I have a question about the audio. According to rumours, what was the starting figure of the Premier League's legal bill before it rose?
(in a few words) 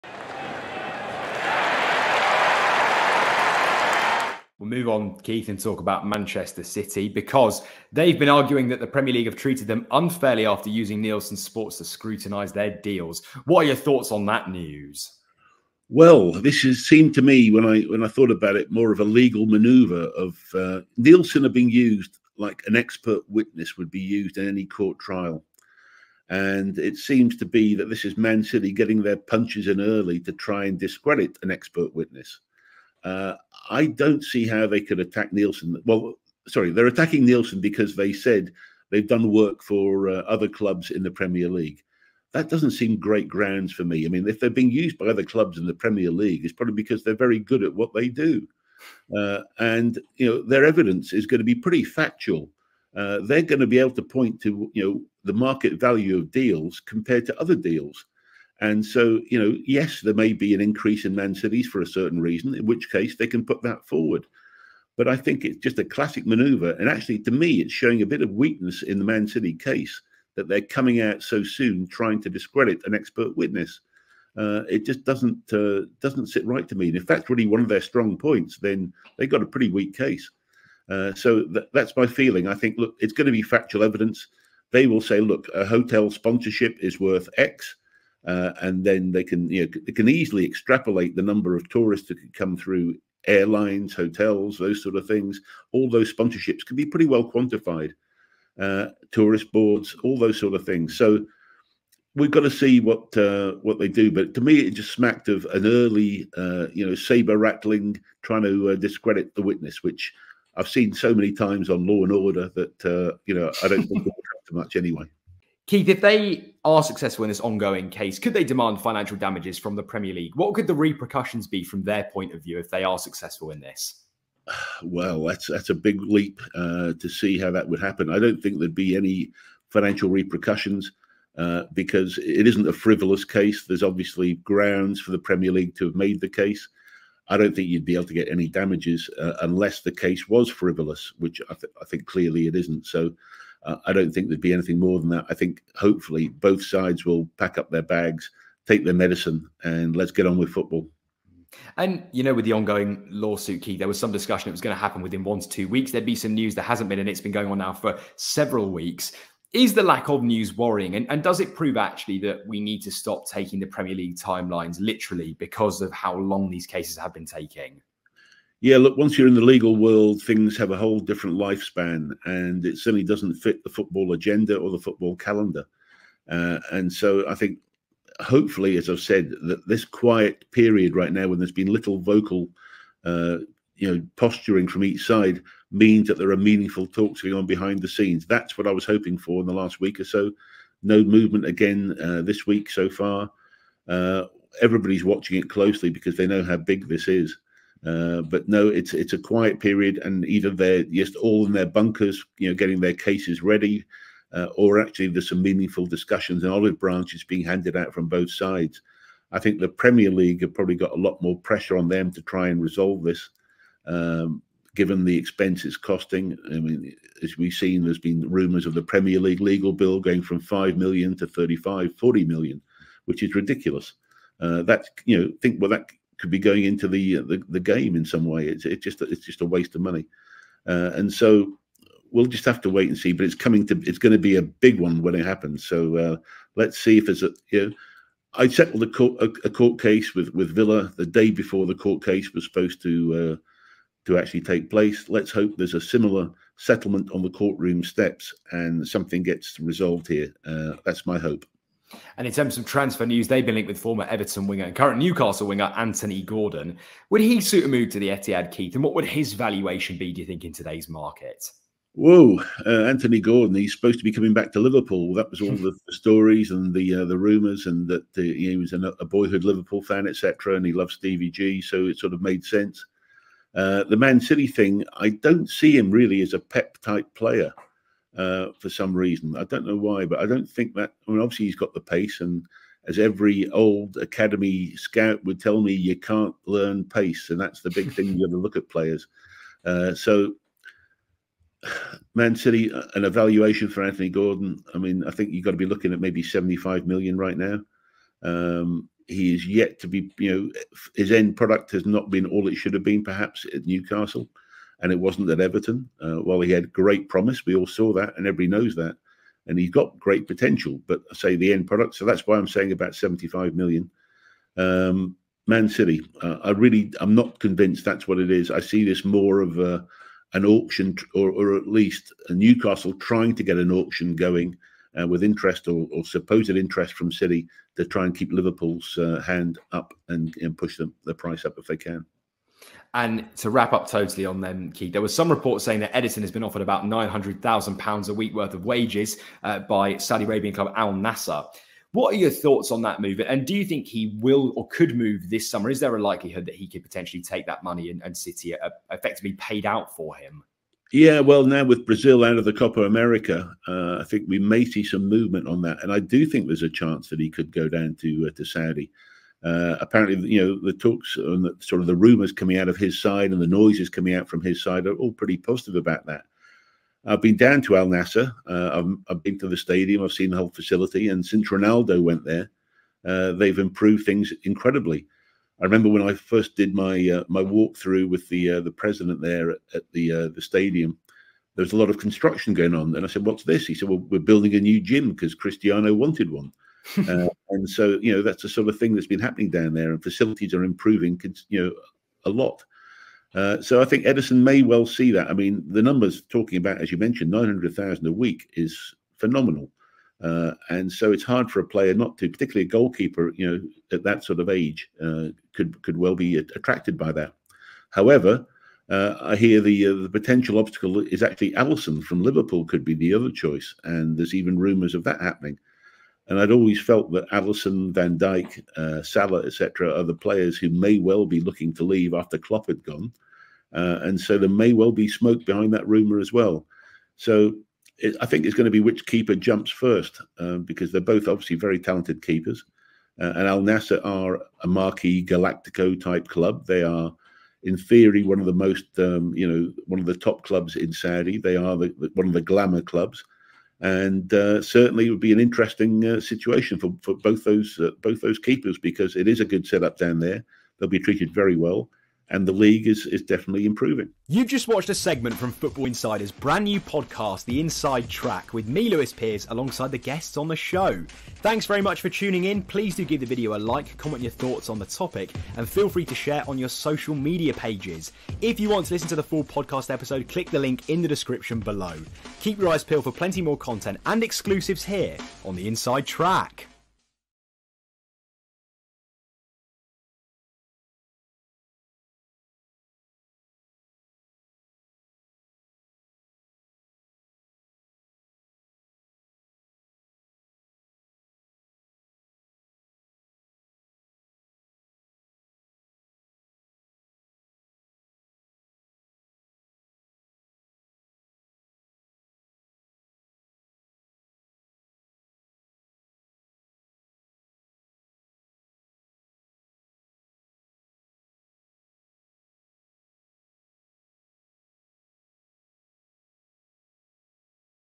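5 million.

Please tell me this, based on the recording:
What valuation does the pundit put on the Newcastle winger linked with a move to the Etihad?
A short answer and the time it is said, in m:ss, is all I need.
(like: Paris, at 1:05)
75 million, at 4:56.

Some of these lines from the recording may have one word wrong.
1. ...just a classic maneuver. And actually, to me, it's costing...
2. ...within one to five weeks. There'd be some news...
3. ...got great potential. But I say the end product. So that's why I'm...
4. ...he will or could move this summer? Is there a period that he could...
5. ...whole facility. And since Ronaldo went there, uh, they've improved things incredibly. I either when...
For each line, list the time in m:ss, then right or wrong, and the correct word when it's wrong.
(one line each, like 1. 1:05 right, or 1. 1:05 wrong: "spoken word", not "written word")
1. 1:05 wrong: "showing", not "costing"
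2. 2:35 wrong: "two", not "five"
3. 5:09 right
4. 5:43 wrong: "likelihood", not "period"
5. 6:10 wrong: "remember", not "either".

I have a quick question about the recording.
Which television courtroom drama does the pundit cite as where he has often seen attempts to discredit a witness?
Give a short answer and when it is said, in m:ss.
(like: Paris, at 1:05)
Law and Order, at 1:51.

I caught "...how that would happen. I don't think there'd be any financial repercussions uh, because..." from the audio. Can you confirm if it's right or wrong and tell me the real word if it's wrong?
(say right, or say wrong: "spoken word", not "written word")
right.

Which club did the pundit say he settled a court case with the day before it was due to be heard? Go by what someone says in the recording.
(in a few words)
Villa.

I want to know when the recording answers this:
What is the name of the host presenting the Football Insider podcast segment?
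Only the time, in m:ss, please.
7:38.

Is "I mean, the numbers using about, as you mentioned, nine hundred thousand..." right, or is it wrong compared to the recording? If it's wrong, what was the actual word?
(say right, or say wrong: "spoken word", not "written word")
wrong: "talking", not "using".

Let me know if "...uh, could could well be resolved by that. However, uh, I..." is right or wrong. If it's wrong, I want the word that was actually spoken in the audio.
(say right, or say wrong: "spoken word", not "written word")
wrong: "attracted", not "resolved".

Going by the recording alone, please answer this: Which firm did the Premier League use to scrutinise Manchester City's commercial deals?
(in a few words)
Nielsen Sports.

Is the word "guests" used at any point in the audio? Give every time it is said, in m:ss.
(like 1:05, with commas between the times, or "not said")
7:39.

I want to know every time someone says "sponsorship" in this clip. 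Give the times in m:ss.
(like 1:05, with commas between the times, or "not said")
1:26, 1:36.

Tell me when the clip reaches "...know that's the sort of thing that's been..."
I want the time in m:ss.
6:28.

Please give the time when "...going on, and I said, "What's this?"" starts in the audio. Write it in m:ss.
6:22.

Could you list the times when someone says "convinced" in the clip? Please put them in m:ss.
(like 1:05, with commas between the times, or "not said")
5:17.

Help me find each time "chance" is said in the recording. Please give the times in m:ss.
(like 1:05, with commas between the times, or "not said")
5:56.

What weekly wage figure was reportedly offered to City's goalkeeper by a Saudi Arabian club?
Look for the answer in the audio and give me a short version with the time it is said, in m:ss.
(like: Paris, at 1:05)
£900,000, at 5:36.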